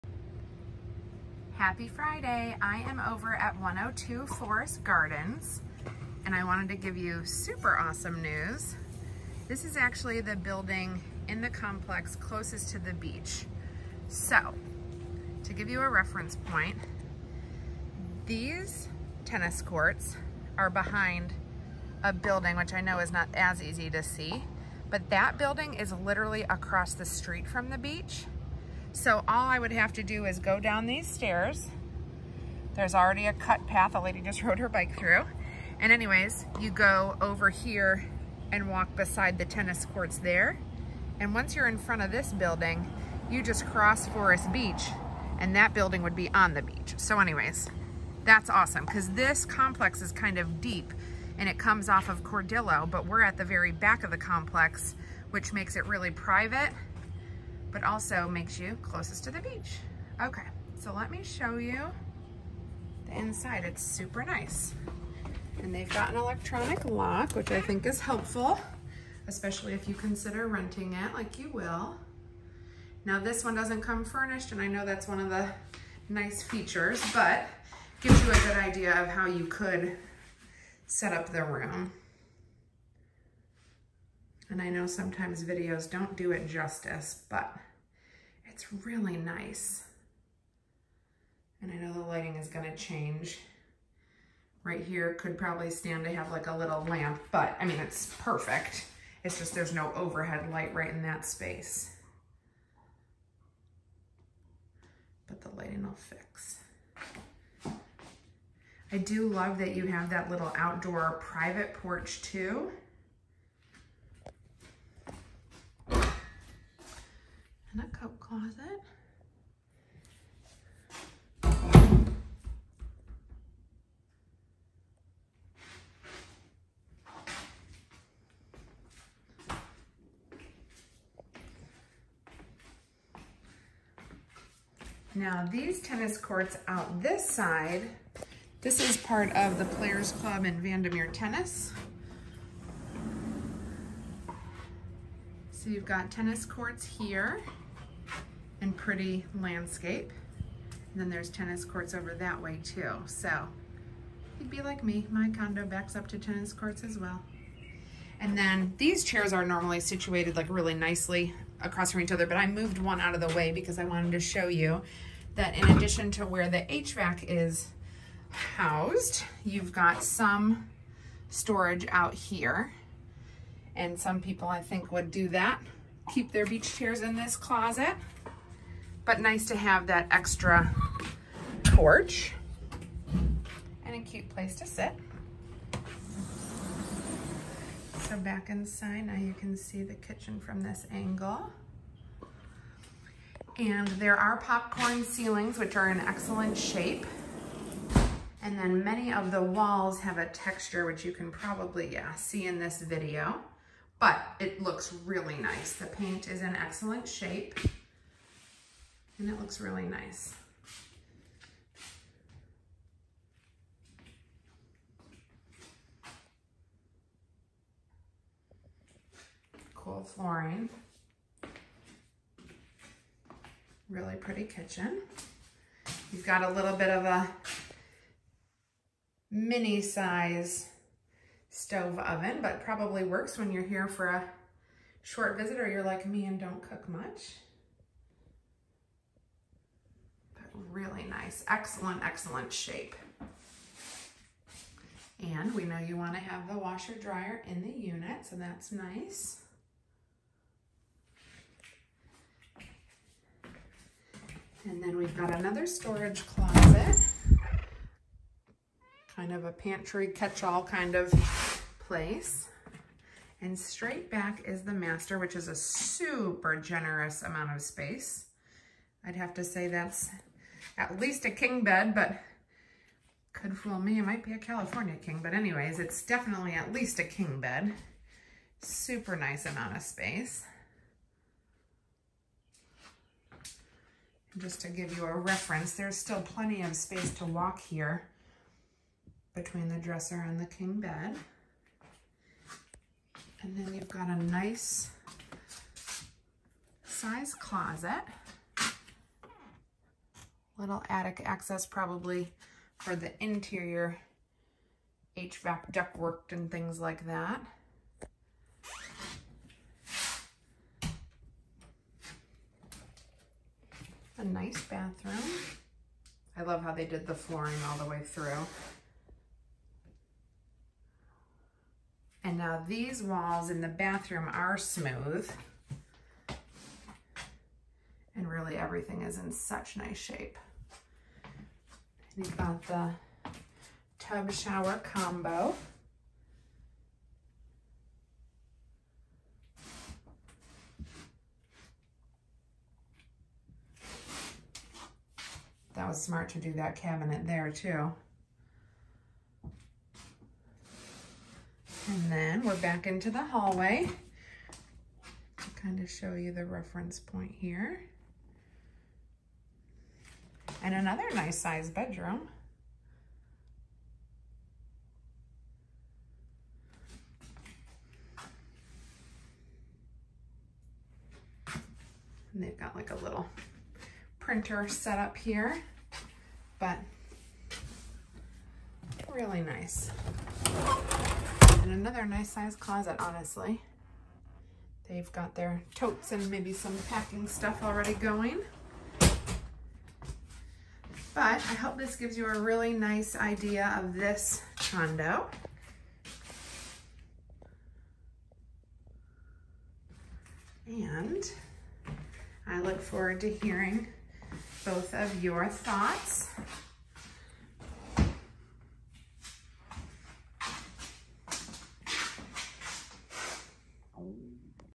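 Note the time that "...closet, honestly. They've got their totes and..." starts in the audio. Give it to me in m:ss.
6:22.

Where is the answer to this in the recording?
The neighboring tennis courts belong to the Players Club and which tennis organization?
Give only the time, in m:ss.
2:20.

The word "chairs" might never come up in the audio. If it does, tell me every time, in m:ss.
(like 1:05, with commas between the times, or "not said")
2:39, 2:56.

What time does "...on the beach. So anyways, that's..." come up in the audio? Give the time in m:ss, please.
0:46.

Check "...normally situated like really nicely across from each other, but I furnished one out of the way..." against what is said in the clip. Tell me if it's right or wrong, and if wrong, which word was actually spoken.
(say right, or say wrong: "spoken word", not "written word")
wrong: "moved", not "furnished".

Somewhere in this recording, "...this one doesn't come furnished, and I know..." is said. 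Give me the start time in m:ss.
1:13.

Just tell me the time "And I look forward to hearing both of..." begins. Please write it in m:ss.
6:40.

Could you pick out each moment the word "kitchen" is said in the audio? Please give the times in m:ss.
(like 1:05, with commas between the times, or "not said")
3:09, 3:44.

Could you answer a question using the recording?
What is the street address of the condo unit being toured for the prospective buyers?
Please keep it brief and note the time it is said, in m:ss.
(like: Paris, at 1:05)
102 Forest Gardens, at 0:03.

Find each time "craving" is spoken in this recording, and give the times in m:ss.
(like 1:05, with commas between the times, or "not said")
not said.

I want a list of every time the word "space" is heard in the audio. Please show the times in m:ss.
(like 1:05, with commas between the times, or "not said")
1:41, 4:27, 4:39, 4:46.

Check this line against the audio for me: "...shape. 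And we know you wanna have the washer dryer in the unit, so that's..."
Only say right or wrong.
right.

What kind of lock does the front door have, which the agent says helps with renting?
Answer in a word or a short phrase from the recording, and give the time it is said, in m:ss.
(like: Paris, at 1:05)
Electronic lock, at 1:06.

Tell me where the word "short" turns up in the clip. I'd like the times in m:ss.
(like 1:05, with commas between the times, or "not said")
3:55.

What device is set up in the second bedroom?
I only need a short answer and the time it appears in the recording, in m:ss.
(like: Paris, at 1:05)
Printer, at 6:14.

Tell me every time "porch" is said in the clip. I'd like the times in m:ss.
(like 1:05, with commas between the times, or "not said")
1:51, 3:01.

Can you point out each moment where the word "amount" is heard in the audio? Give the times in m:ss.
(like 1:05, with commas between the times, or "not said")
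4:27, 4:39.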